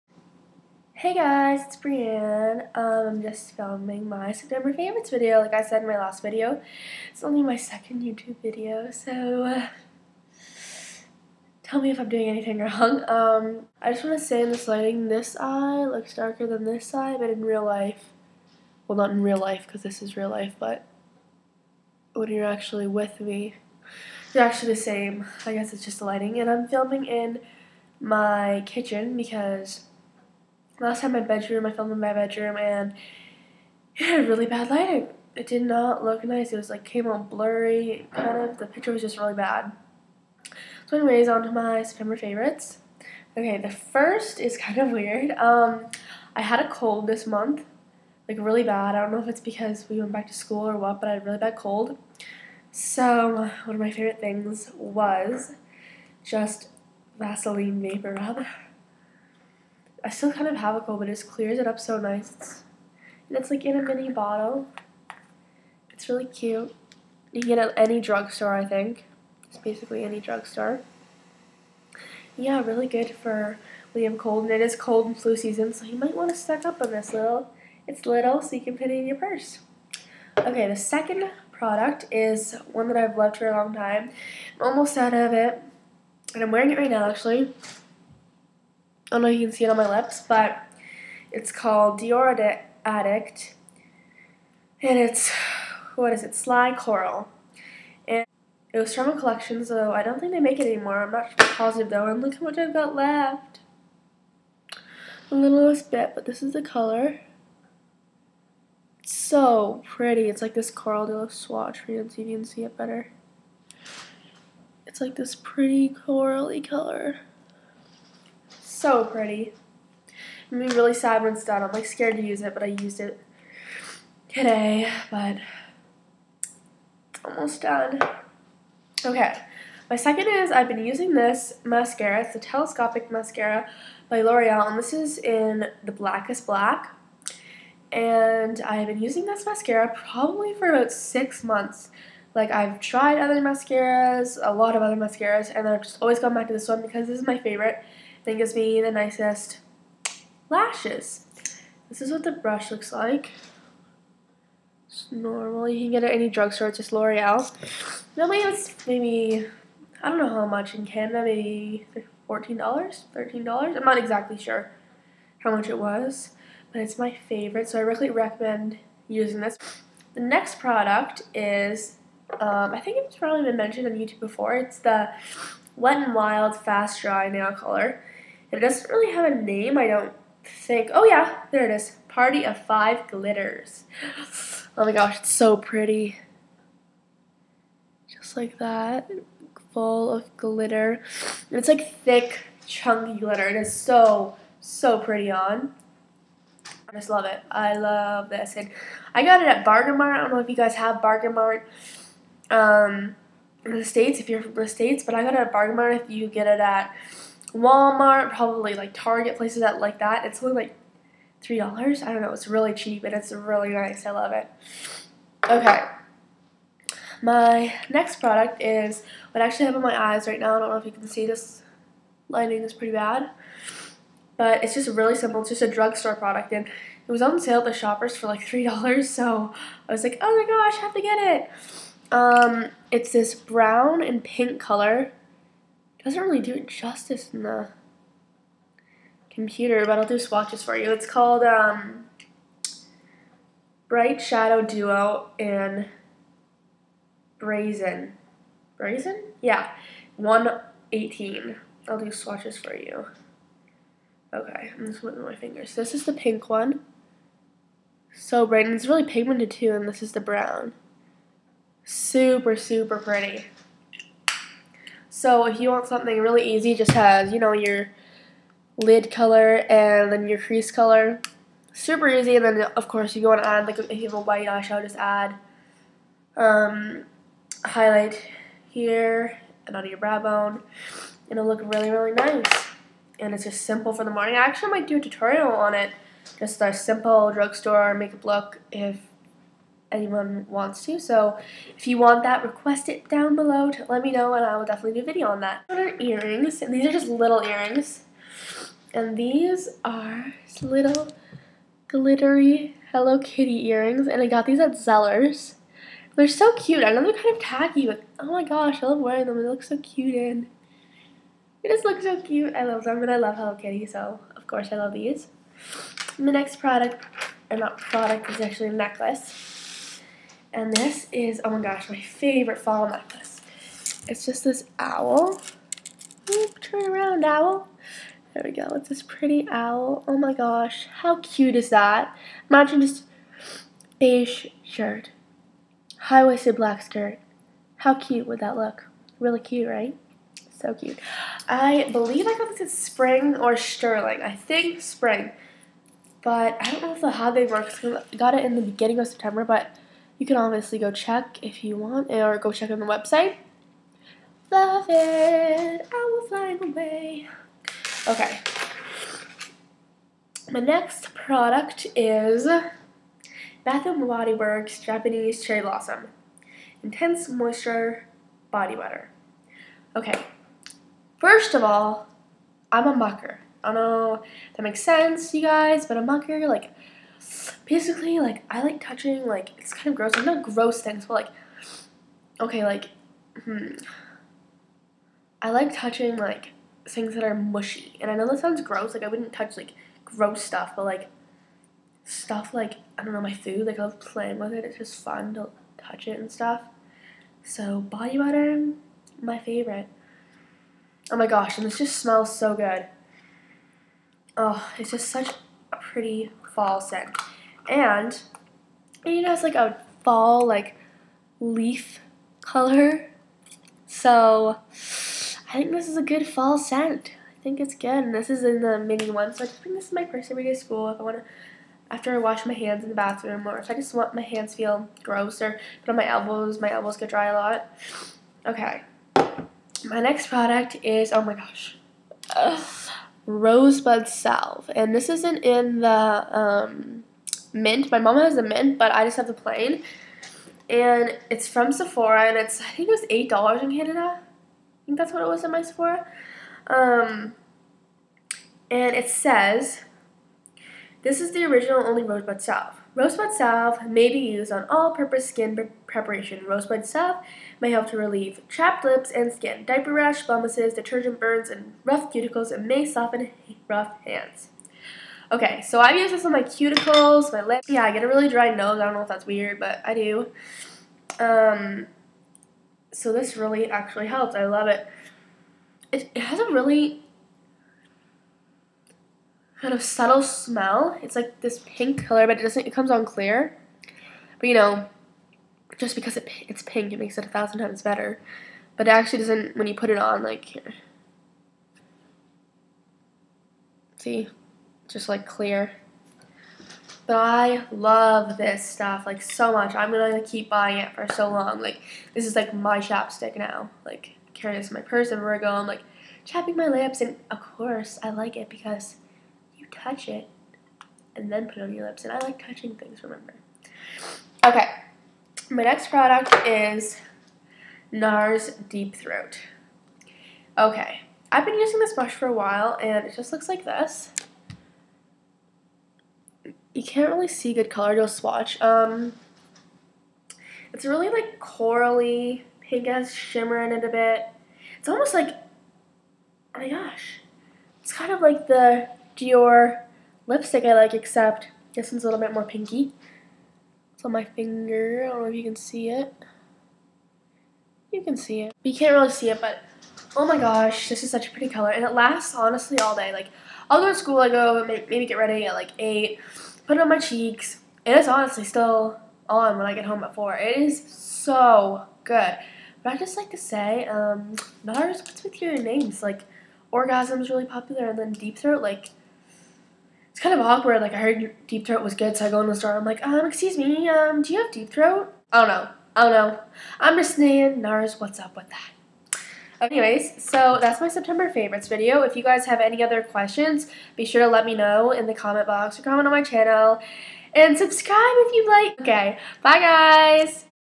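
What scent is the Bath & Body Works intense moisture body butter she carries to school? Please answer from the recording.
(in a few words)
Japanese Cherry Blossom.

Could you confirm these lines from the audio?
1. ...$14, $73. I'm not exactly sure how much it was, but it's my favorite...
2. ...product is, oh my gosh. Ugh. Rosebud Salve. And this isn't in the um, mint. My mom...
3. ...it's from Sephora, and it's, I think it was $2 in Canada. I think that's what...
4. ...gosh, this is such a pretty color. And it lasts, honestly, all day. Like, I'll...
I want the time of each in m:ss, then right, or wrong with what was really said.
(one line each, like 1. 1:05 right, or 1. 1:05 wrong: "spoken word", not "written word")
1. 2:42 wrong: "13", not "73"
2. 7:10 right
3. 7:21 wrong: "8", not "2"
4. 9:10 right.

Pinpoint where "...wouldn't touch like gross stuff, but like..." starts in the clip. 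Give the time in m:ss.
6:29.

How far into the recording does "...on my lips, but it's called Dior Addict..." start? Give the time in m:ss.
1:29.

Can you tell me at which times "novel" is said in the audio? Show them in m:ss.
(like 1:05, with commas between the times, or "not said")
not said.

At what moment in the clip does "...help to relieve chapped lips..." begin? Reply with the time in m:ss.
7:37.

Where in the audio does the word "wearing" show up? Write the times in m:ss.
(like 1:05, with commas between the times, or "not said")
1:26, 5:08.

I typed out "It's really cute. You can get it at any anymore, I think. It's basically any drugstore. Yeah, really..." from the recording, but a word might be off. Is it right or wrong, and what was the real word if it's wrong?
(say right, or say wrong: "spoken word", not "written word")
wrong: "drugstore", not "anymore".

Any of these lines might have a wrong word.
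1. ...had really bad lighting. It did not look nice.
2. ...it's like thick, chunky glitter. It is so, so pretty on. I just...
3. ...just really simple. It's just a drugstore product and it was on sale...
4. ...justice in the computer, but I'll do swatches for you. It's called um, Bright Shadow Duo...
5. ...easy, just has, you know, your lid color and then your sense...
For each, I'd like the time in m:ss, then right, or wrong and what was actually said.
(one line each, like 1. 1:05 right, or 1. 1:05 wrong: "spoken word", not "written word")
1. 0:34 right
2. 3:11 right
3. 3:44 right
4. 3:56 right
5. 4:26 wrong: "crease", not "sense".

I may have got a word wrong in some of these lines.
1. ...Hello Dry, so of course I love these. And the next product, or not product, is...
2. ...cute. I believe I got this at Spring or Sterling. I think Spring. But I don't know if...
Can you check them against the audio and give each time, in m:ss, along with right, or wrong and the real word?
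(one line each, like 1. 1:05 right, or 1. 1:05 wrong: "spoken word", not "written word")
1. 5:13 wrong: "Kitty", not "Dry"
2. 5:40 right.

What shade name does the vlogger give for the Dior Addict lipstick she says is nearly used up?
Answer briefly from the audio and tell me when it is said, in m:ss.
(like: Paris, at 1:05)
Sly Coral, at 1:36.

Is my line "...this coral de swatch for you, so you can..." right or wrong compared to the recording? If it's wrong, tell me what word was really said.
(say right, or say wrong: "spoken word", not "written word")
right.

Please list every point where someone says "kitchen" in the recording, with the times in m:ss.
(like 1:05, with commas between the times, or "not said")
0:28.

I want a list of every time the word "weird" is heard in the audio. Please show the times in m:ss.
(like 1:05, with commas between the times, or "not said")
0:44, 7:49.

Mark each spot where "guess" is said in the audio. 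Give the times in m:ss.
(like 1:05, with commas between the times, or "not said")
0:25.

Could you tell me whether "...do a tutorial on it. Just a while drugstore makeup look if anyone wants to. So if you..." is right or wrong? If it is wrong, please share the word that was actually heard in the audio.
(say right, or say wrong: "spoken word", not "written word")
wrong: "simple", not "while".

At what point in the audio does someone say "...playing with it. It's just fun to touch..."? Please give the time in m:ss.
6:33.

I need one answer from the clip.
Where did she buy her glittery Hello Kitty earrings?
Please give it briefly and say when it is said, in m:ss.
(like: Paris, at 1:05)
Zellers, at 5:04.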